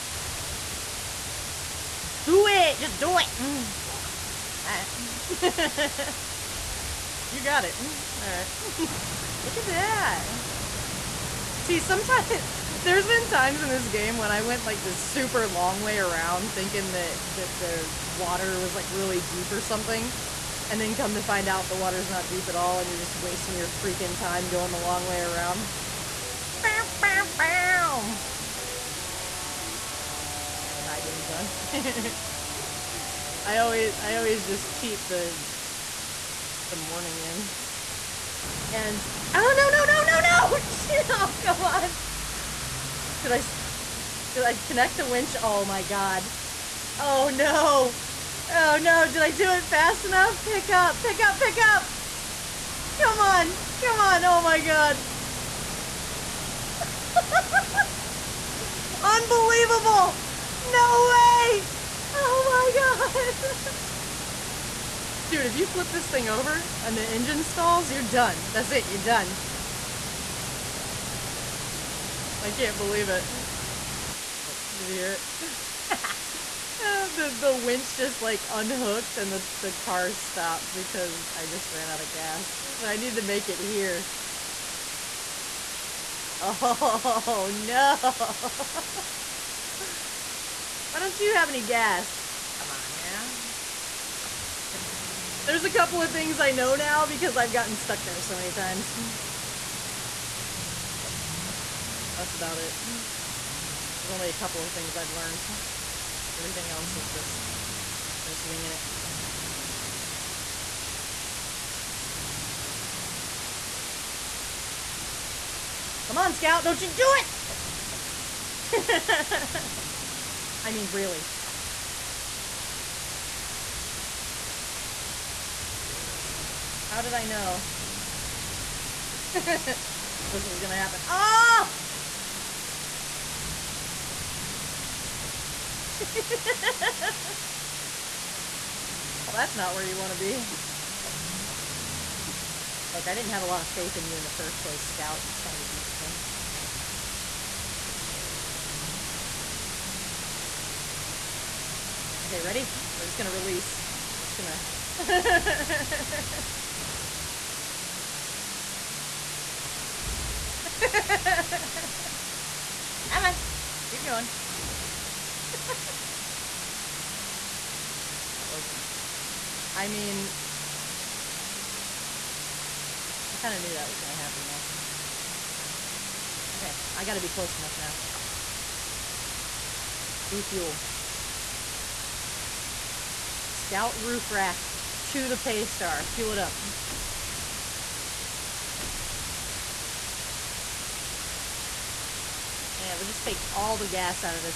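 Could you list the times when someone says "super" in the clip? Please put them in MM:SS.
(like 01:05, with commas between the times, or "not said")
00:14.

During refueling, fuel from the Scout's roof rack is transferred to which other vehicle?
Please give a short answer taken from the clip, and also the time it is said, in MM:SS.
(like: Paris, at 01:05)
Paystar, at 03:05.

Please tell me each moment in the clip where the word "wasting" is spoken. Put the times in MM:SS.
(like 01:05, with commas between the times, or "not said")
00:23.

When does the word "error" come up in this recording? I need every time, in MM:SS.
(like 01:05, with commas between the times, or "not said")
not said.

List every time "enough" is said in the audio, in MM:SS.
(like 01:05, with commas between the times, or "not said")
00:50, 02:57.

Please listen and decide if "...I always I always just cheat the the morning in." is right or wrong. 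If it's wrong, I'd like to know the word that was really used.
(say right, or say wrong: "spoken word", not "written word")
right.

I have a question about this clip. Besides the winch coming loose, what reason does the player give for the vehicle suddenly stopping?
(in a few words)
Ran out of gas.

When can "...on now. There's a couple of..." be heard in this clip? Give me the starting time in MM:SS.
01:32.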